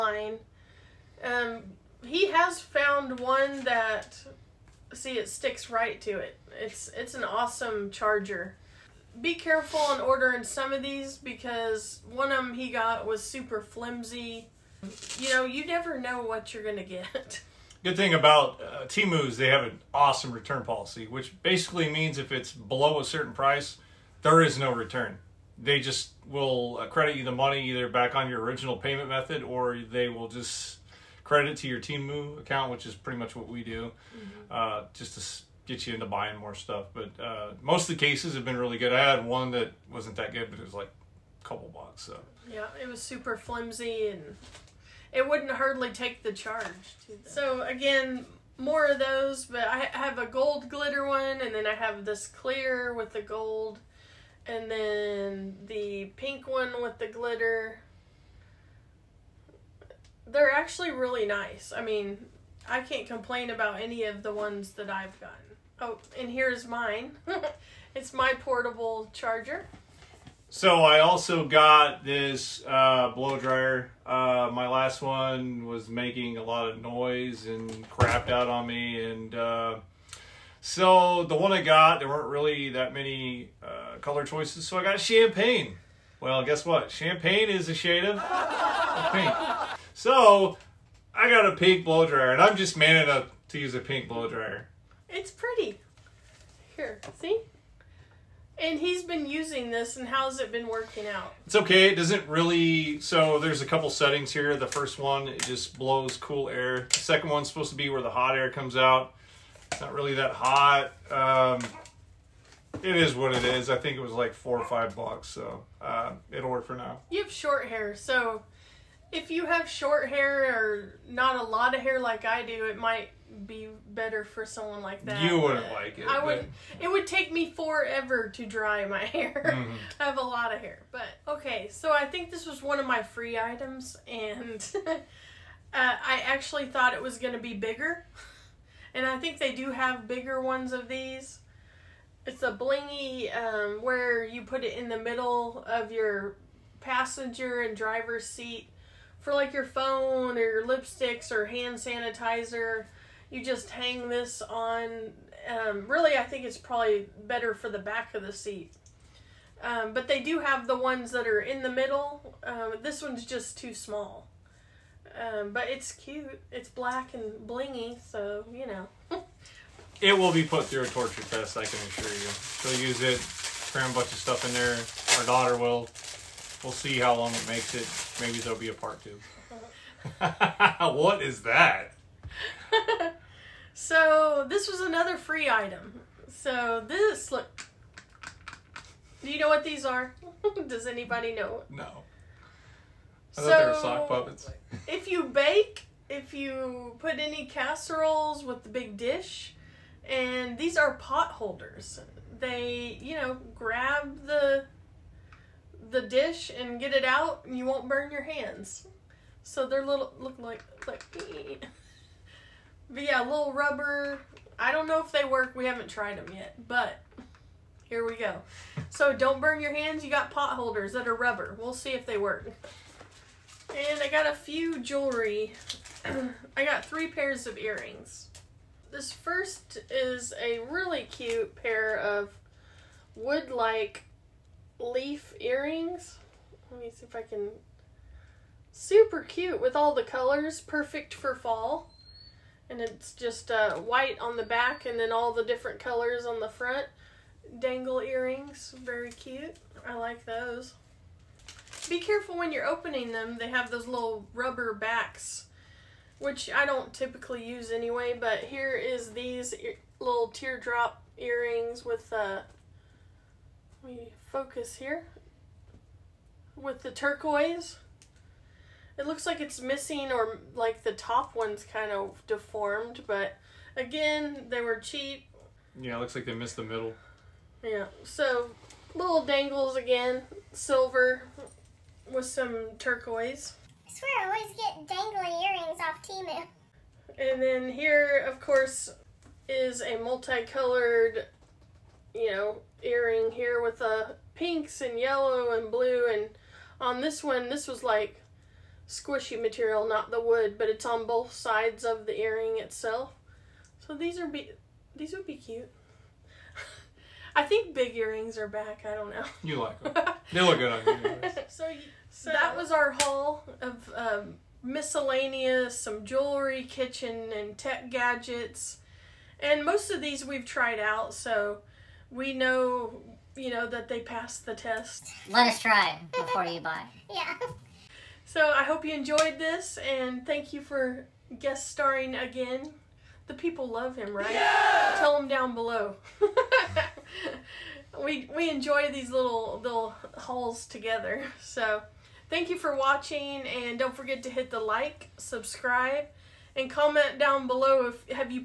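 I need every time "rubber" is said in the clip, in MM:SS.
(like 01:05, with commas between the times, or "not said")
03:33, 03:41, 04:14.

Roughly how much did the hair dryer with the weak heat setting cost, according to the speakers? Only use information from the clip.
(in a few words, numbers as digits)
4 or 5 dollars.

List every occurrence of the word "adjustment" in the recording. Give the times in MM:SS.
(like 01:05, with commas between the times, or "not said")
not said.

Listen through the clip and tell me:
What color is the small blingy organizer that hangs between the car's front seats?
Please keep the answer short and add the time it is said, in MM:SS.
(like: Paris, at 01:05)
black, at 02:46.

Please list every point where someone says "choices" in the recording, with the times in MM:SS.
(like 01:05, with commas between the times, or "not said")
01:24.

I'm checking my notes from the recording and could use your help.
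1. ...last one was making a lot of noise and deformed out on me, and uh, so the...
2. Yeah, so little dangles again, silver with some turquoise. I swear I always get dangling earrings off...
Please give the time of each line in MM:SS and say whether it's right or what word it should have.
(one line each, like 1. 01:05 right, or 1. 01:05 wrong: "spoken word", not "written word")
1. 01:14 wrong: "crapped", not "deformed"
2. 04:37 right.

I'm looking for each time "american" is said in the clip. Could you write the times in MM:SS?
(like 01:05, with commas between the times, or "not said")
not said.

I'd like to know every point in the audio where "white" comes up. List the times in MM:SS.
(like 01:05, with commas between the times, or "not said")
04:03.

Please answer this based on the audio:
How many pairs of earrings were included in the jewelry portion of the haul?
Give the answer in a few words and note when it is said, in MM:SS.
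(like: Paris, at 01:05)
3, at 03:46.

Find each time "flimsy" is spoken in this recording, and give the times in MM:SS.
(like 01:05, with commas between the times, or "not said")
00:13, 00:43.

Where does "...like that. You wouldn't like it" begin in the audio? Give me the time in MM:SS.
02:04.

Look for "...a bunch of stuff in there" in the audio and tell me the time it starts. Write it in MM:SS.
02:53.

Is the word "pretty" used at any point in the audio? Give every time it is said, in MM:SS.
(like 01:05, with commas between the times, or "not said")
00:32, 01:35.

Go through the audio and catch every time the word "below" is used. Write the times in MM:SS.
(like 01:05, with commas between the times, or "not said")
00:22, 05:35, 05:47.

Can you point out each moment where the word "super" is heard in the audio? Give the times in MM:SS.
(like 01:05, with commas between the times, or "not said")
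00:13, 00:43, 03:58.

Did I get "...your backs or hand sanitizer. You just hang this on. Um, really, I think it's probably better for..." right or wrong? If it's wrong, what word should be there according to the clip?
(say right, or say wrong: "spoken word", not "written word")
wrong: "lipsticks", not "backs".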